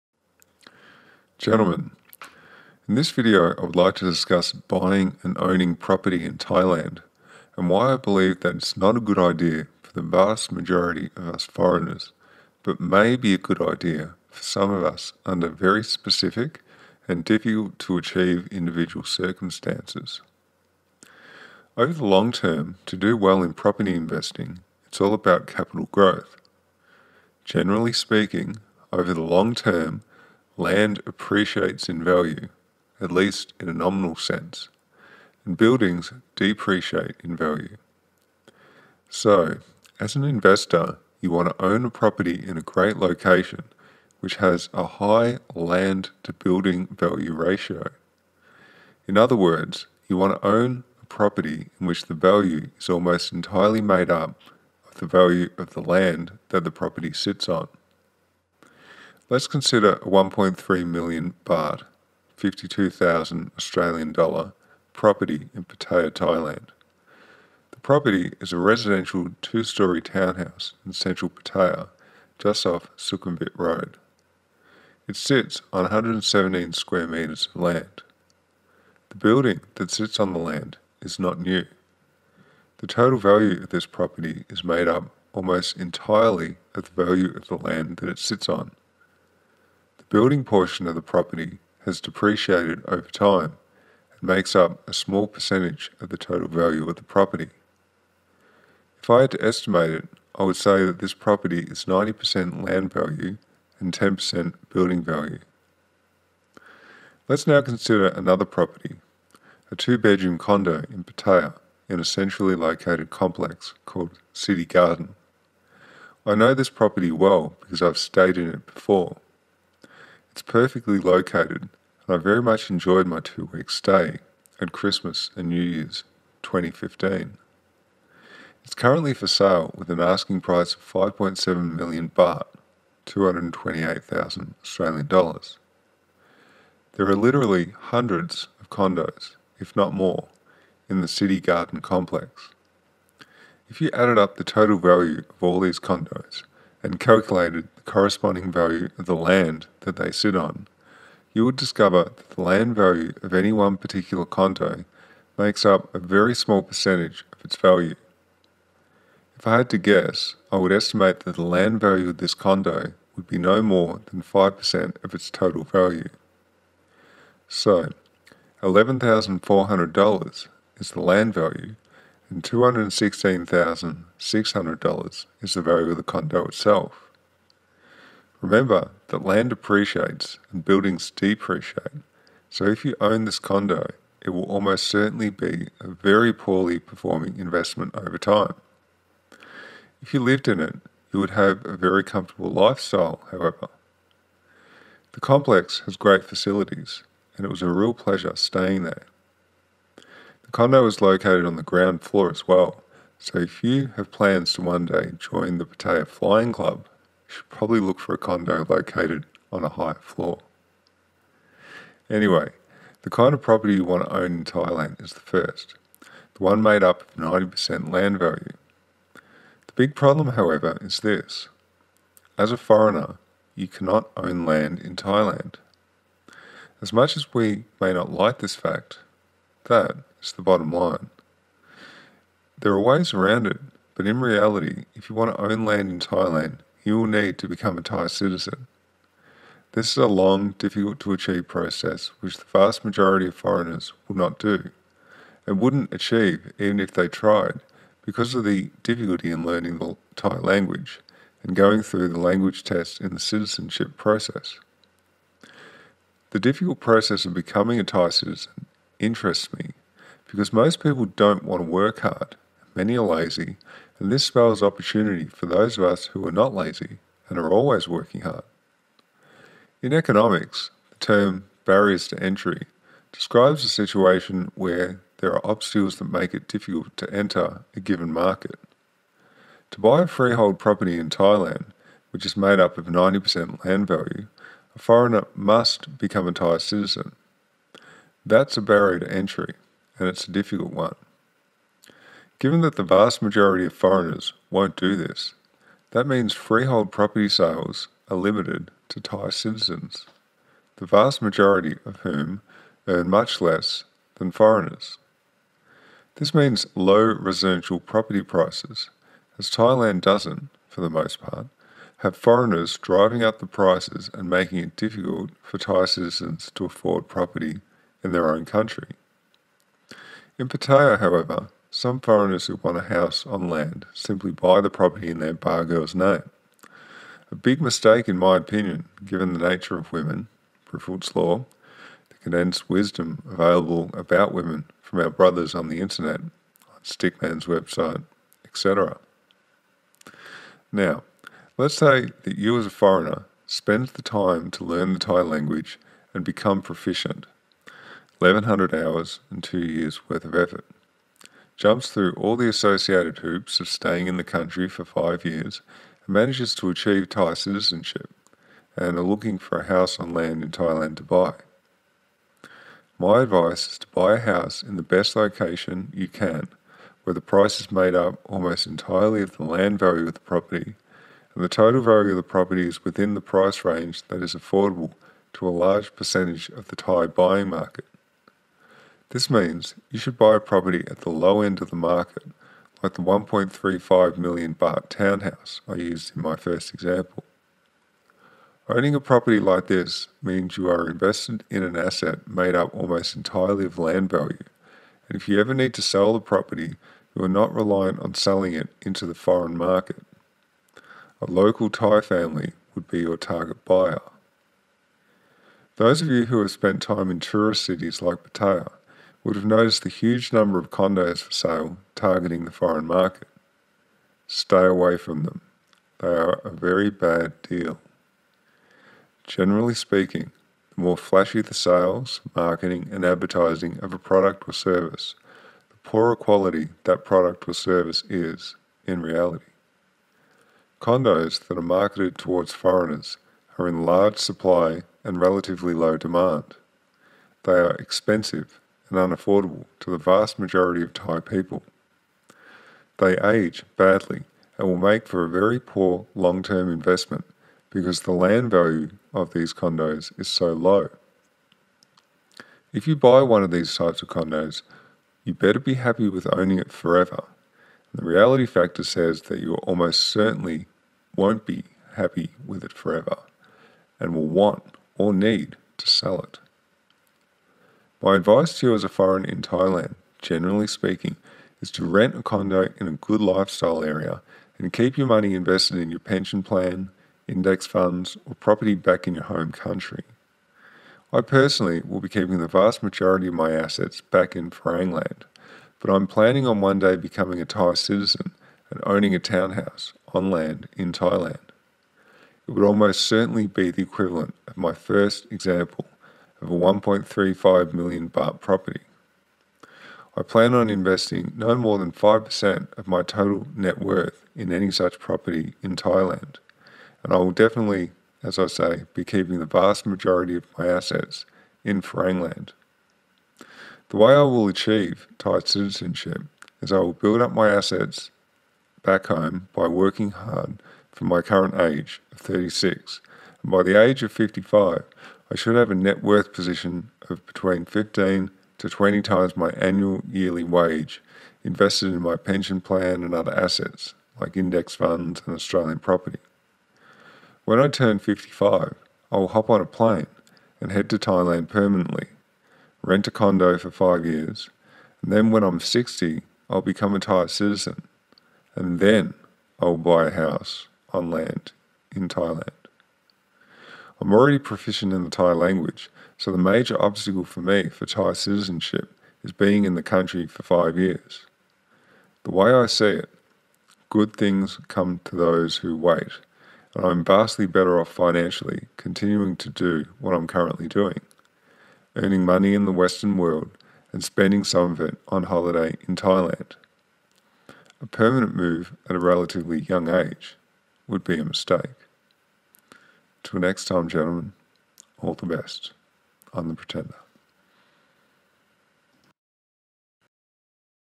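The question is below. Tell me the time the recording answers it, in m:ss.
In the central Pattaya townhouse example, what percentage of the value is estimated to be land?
1:41.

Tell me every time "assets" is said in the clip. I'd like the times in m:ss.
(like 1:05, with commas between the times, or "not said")
6:31, 8:03, 8:30, 8:37, 8:53.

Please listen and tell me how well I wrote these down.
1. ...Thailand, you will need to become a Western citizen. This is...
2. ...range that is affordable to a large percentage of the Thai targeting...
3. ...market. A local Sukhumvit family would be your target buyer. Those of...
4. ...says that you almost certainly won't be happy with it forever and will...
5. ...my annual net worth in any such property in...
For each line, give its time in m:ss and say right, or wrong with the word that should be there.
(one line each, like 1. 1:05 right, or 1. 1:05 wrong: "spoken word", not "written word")
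1. 3:55 wrong: "Thai", not "Western"
2. 6:13 wrong: "buying", not "targeting"
3. 6:39 wrong: "Thai", not "Sukhumvit"
4. 7:38 right
5. 8:22 wrong: "total", not "annual".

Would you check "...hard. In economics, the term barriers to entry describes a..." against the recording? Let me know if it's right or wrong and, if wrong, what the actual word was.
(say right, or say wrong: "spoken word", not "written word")
right.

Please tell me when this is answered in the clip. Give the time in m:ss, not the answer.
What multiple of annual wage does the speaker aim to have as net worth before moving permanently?
8:47.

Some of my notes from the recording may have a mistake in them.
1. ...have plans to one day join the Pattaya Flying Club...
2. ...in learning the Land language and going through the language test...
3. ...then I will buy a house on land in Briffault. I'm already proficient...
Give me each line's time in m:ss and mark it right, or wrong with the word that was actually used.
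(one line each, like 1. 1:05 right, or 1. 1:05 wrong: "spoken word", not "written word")
1. 3:23 right
2. 4:09 wrong: "Thai", not "Land"
3. 9:08 wrong: "Thailand", not "Briffault".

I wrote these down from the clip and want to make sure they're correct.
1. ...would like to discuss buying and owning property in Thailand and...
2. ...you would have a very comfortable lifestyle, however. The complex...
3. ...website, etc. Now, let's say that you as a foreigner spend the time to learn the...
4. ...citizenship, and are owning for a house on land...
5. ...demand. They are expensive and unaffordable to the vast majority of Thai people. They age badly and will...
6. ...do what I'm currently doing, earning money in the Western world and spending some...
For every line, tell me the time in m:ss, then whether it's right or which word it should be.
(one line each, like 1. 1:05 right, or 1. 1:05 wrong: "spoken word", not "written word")
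1. 0:03 right
2. 3:11 right
3. 5:37 right
4. 5:57 wrong: "looking", not "owning"
5. 7:15 right
6. 9:29 right.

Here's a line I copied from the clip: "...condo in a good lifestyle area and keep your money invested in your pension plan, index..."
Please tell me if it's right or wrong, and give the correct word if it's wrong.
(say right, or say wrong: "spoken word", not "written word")
right.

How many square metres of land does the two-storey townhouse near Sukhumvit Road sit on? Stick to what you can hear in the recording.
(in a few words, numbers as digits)
117.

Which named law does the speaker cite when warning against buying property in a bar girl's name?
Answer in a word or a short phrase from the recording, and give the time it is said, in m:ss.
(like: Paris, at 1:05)
Briffault's Law, at 5:30.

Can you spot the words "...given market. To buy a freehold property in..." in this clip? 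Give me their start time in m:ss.
4:37.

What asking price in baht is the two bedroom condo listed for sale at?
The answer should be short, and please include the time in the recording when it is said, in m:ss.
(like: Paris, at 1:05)
5.7 million baht, at 2:10.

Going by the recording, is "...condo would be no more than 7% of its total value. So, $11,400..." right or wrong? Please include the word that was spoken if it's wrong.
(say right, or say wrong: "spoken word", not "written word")
wrong: "5", not "7".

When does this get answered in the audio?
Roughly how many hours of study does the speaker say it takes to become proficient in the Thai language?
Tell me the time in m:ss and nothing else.
5:48.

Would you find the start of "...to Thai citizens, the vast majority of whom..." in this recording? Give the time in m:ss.
4:58.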